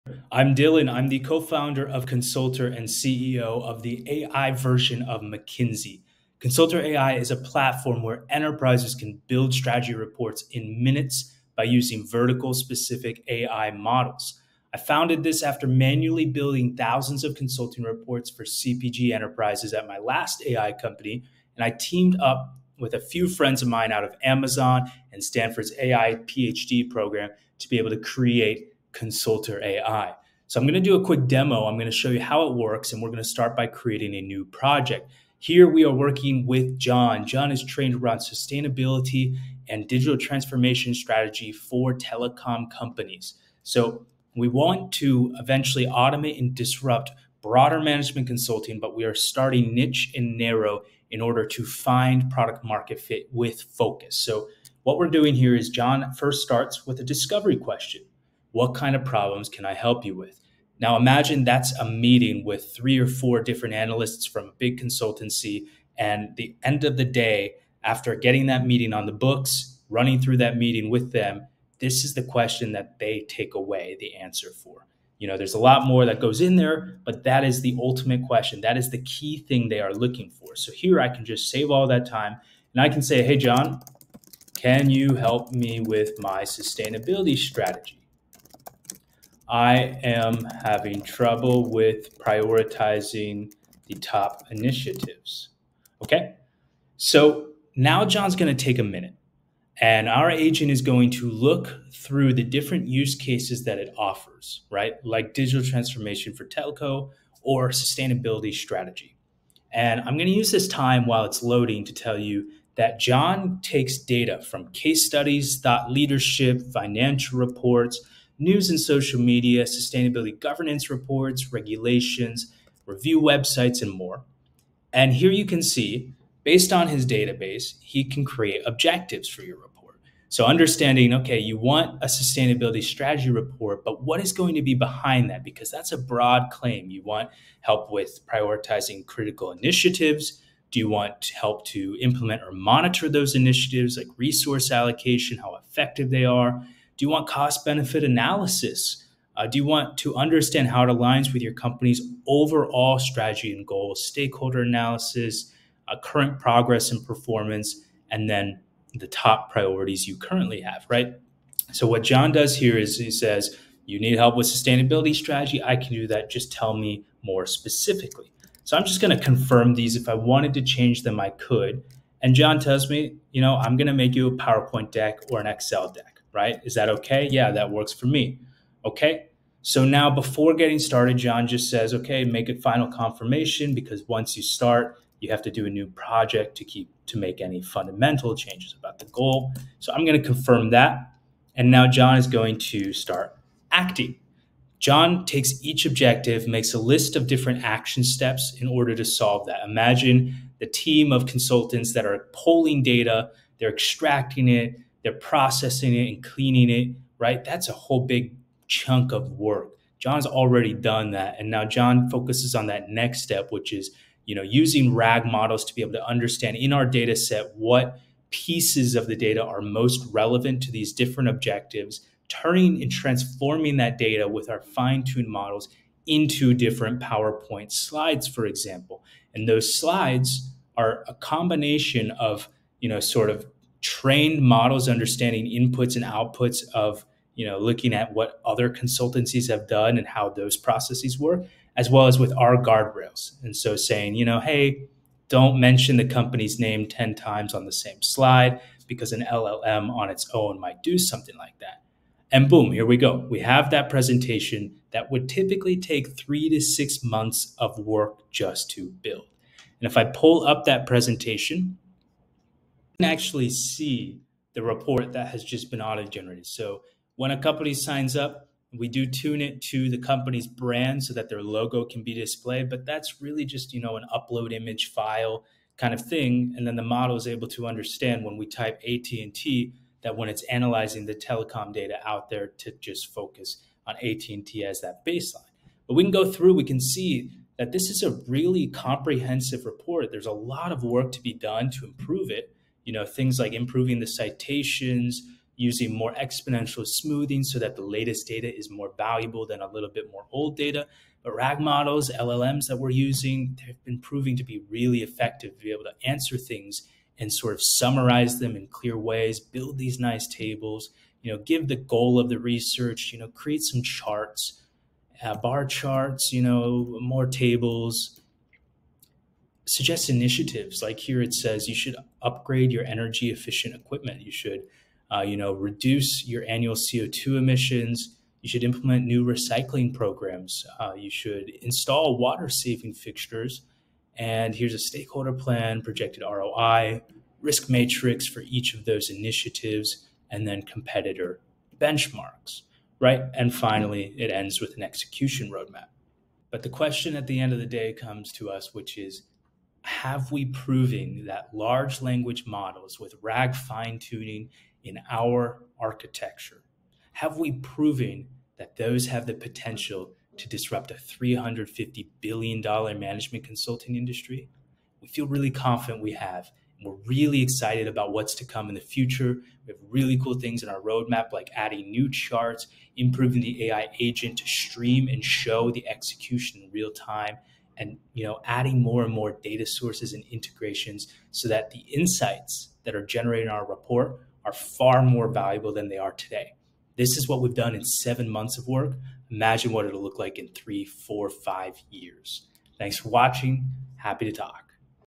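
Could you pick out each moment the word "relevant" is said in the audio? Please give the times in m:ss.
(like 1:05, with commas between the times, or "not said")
3:40.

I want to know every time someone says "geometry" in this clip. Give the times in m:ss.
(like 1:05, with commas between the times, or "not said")
not said.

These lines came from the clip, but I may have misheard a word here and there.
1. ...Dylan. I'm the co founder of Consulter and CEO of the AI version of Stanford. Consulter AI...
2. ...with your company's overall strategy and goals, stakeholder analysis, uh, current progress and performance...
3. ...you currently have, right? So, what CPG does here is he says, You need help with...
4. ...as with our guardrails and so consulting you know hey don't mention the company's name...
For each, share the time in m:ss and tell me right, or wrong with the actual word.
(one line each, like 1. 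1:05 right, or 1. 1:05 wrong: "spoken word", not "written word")
1. 0:00 wrong: "McKinsey", not "Stanford"
2. 2:31 right
3. 2:40 wrong: "John", not "CPG"
4. 4:02 wrong: "saying", not "consulting".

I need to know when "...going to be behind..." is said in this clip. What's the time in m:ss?
2:14.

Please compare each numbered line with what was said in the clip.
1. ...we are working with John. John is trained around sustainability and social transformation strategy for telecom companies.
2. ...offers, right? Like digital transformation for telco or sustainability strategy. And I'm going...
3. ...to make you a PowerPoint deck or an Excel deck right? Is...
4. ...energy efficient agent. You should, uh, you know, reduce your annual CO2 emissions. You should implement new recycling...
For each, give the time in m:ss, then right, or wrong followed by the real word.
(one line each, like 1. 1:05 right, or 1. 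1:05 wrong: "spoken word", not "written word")
1. 0:35 wrong: "digital", not "social"
2. 1:43 right
3. 2:53 right
4. 5:22 wrong: "equipment", not "agent".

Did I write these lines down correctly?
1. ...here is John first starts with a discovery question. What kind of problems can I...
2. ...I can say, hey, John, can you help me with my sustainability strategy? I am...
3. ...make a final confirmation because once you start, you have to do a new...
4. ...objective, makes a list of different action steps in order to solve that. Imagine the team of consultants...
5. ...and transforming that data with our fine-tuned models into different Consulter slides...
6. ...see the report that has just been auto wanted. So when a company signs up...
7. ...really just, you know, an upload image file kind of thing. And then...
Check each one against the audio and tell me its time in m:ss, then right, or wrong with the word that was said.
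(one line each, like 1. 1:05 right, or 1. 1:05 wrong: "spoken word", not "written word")
1. 0:55 right
2. 1:22 right
3. 3:02 right
4. 3:15 right
5. 3:42 wrong: "PowerPoint", not "Consulter"
6. 4:23 wrong: "generated", not "wanted"
7. 4:33 right.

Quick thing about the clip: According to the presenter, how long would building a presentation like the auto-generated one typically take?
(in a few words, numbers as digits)
3 to 6 months.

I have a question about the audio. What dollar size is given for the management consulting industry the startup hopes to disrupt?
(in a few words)
$350 billion.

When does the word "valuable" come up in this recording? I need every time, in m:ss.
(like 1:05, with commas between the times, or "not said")
4:58, 6:25.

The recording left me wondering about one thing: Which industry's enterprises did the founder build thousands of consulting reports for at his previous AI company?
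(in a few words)
CPG.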